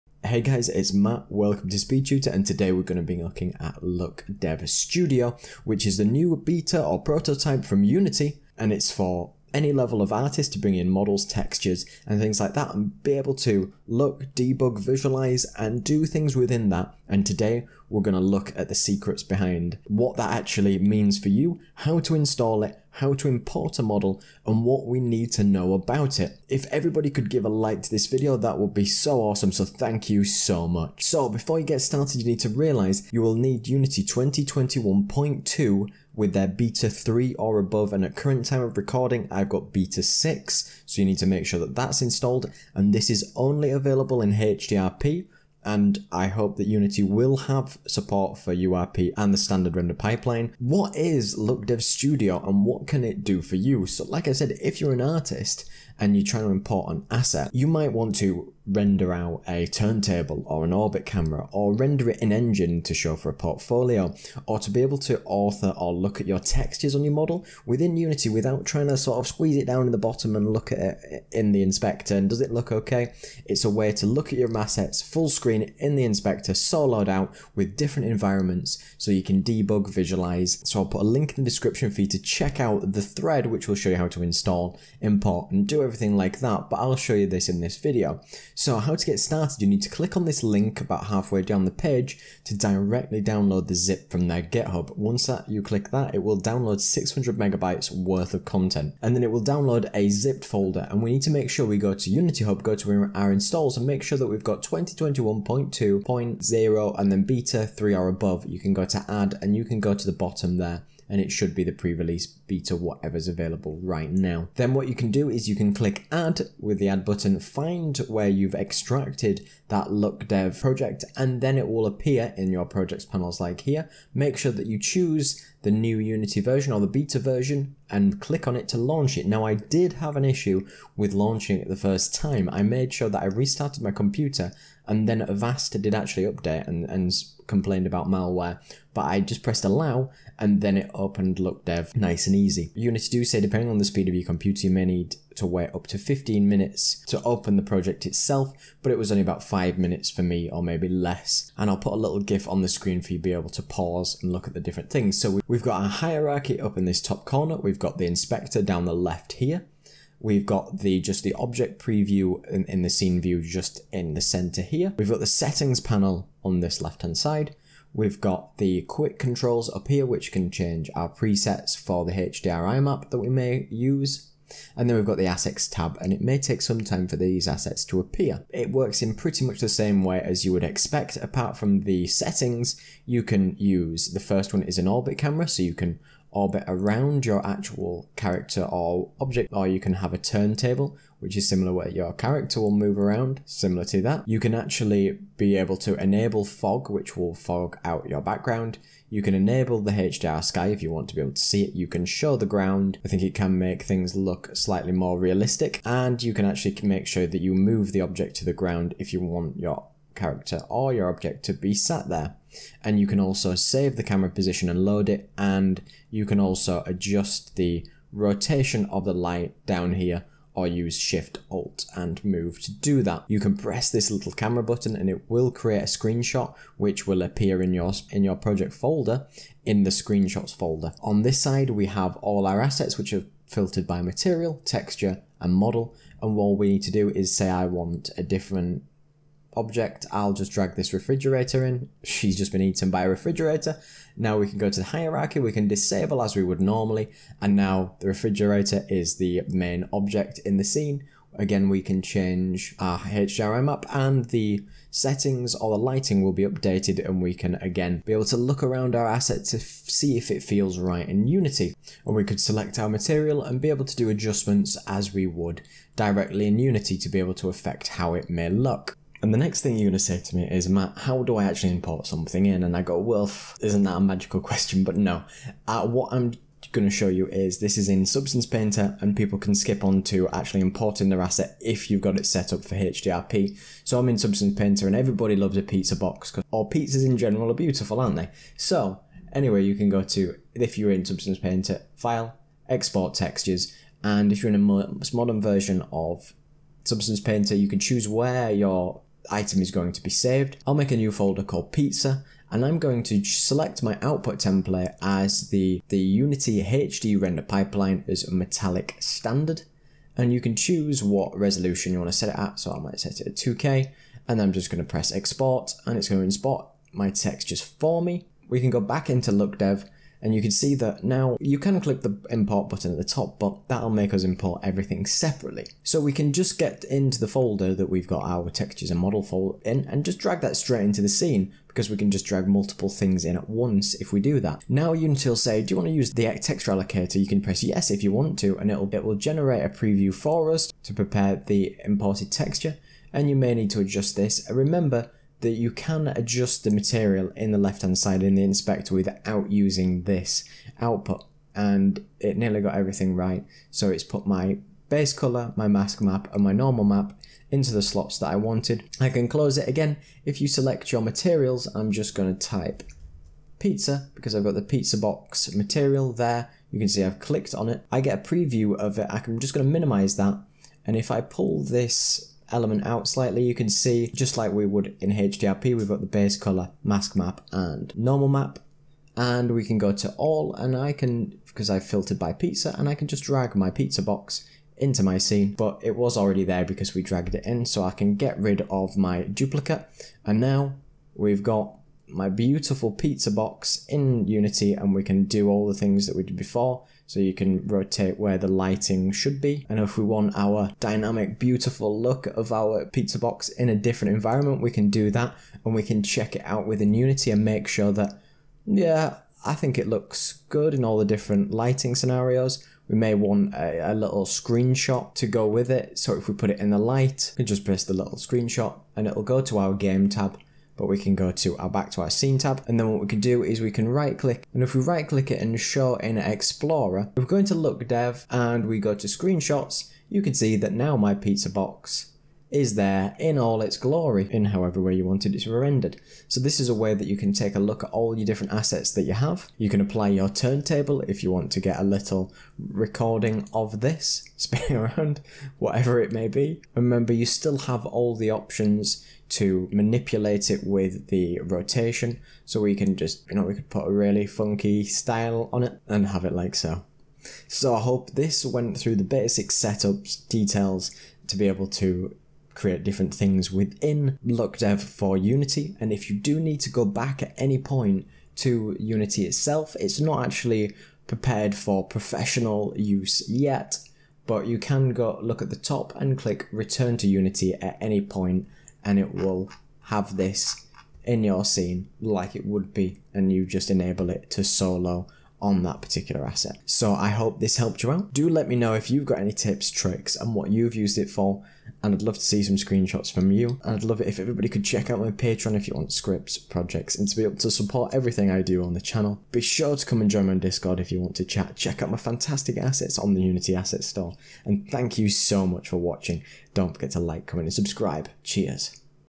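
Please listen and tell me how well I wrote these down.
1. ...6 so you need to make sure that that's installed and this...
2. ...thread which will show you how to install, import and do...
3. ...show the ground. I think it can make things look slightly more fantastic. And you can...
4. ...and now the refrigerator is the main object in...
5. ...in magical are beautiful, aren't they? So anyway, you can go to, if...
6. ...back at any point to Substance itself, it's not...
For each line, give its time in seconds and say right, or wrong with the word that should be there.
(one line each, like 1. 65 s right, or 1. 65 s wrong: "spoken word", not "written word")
1. 40 s right
2. 83 s right
3. 202 s wrong: "realistic", not "fantastic"
4. 247 s right
5. 287 s wrong: "general", not "magical"
6. 466 s wrong: "Unity", not "Substance".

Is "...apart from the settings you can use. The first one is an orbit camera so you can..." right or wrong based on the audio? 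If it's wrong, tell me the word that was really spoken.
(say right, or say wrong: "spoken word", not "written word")
right.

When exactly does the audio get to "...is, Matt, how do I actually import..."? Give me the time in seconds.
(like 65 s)
270 s.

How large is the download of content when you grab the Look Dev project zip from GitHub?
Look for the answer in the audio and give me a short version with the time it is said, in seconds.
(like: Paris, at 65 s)
600 megabytes, at 96 s.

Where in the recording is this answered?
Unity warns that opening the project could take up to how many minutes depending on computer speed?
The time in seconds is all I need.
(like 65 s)
145 s.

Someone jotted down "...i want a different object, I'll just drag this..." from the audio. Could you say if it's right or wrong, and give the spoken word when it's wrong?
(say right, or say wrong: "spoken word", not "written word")
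right.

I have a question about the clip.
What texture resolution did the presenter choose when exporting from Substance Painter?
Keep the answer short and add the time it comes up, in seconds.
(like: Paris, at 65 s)
2K, at 313 s.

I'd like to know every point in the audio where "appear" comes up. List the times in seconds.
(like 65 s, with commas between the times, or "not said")
121 s, 177 s, 227 s.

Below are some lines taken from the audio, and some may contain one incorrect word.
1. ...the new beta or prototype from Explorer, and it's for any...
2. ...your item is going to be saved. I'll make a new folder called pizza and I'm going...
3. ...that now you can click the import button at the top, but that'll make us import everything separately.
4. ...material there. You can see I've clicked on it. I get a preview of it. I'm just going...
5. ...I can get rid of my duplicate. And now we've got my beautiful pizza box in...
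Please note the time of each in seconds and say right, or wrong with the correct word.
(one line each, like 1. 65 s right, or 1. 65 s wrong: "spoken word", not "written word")
1. 5 s wrong: "Unity", not "Explorer"
2. 298 s right
3. 320 s right
4. 365 s right
5. 387 s right.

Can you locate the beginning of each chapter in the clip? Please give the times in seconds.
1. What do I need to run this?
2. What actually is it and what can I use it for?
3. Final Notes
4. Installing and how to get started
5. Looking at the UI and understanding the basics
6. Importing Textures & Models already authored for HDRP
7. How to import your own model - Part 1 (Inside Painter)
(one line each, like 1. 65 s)
1. 31 s
2. 50 s
3. 400 s
4. 88 s
5. 154 s
6. 325 s
7. 269 s.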